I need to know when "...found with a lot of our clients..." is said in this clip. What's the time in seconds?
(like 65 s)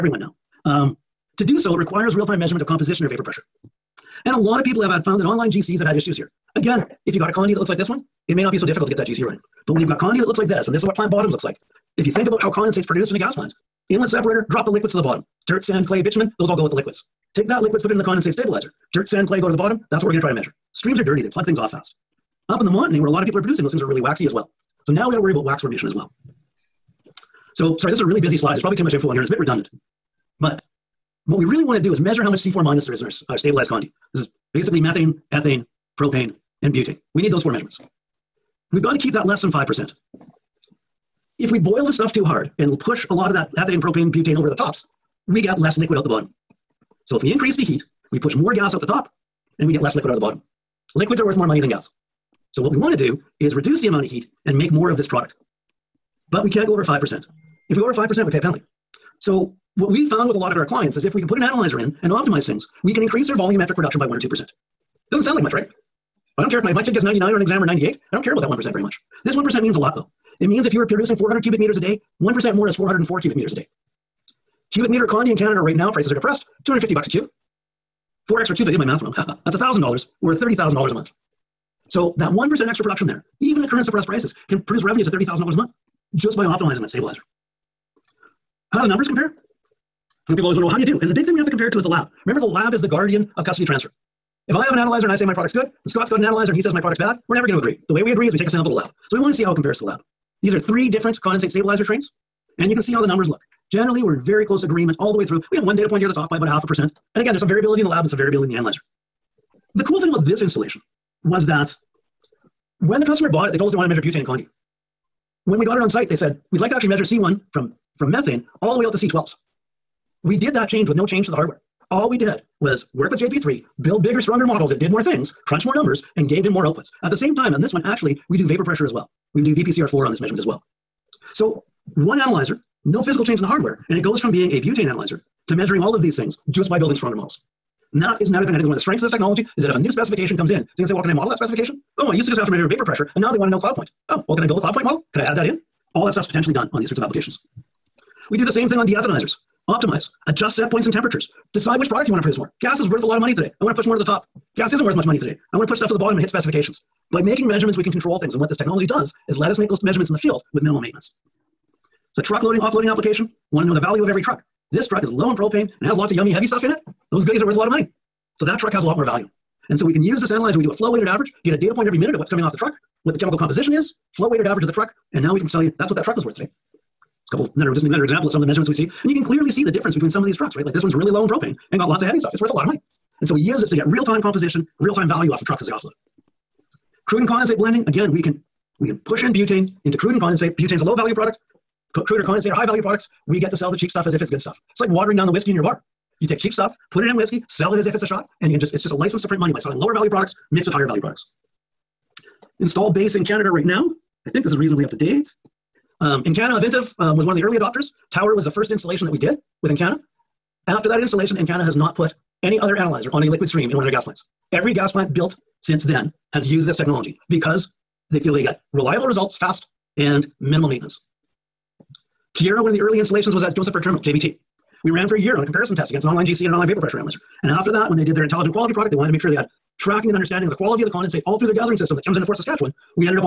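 60 s.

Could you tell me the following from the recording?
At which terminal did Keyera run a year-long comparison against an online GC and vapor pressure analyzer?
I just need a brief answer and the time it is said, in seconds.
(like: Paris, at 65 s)
Josephburg Terminal, at 223 s.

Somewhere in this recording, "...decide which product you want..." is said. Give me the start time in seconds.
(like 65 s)
151 s.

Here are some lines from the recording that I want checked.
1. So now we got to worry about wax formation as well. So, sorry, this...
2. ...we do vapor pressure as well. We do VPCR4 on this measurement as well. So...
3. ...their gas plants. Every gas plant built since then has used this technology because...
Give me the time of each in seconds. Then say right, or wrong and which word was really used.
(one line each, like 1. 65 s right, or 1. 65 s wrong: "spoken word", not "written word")
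1. 24 s right
2. 128 s right
3. 213 s right.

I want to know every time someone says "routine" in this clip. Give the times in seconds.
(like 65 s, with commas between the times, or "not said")
not said.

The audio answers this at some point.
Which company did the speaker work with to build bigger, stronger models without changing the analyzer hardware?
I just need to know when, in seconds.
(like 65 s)
123 s.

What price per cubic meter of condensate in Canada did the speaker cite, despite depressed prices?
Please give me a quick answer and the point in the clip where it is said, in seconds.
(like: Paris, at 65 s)
$250, at 76 s.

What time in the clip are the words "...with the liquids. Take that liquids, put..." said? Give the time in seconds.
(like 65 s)
16 s.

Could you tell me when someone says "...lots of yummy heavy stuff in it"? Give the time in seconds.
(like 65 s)
165 s.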